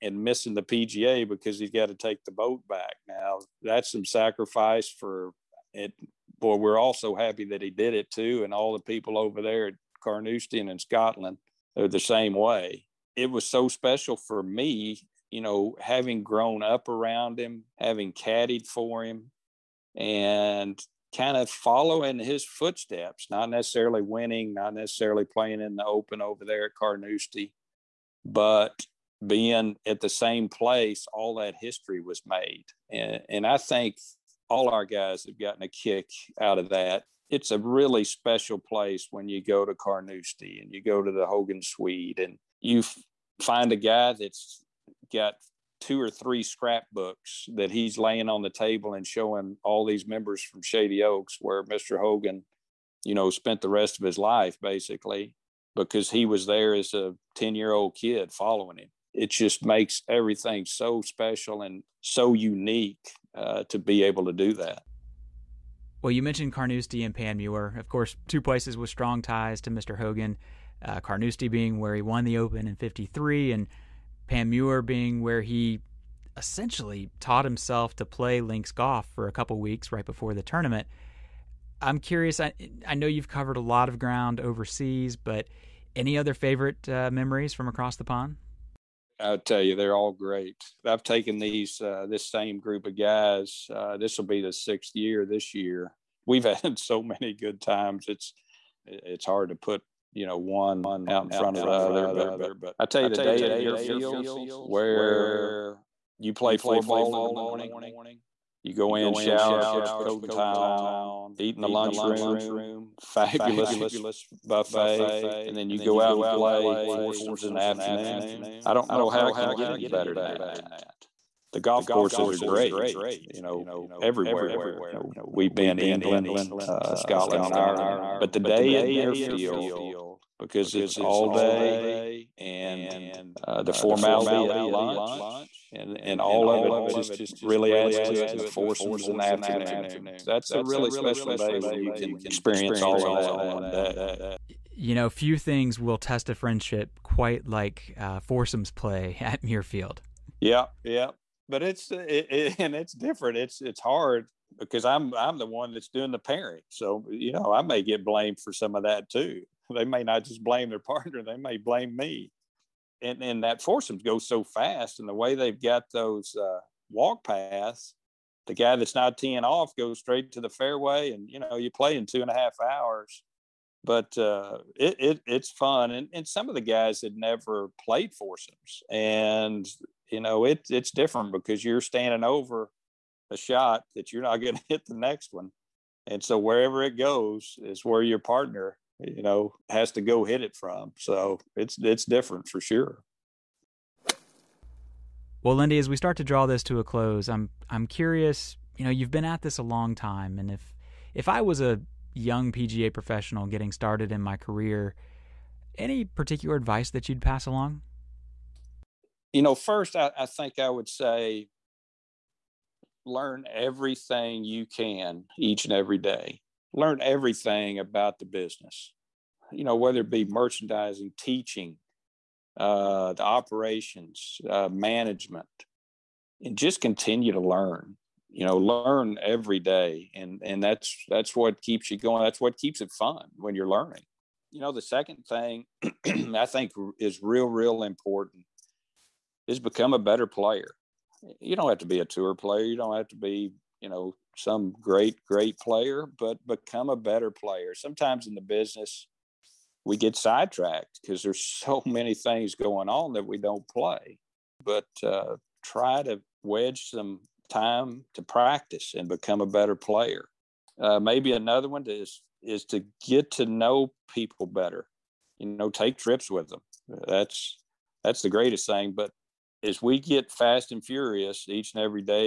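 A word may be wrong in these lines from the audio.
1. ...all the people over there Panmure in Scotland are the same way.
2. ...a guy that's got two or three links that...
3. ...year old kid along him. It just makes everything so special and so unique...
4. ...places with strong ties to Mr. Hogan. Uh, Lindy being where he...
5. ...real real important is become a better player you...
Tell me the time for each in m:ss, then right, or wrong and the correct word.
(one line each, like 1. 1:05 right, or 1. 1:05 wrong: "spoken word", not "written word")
1. 0:08 wrong: "Carnoustie", not "Panmure"
2. 0:43 wrong: "scrapbooks", not "links"
3. 0:57 wrong: "following", not "along"
4. 1:08 wrong: "Carnoustie", not "Lindy"
5. 3:57 right.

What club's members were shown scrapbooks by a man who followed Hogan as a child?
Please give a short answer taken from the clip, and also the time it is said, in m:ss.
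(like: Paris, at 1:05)
Shady Oaks, at 0:50.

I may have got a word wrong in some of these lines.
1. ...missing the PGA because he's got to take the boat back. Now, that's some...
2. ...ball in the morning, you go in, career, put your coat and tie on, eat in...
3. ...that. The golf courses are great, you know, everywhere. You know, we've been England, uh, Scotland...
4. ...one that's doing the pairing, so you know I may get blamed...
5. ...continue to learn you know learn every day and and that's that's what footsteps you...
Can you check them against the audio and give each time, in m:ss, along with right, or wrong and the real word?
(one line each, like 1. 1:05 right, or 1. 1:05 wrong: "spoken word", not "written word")
1. 0:00 right
2. 1:46 wrong: "shower", not "career"
3. 2:00 right
4. 2:35 right
5. 3:46 wrong: "keeps", not "footsteps".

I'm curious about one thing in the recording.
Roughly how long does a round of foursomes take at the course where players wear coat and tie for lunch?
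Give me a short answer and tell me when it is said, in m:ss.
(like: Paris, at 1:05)
2.5 hours, at 2:52.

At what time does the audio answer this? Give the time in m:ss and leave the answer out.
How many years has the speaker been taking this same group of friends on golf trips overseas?
1:34.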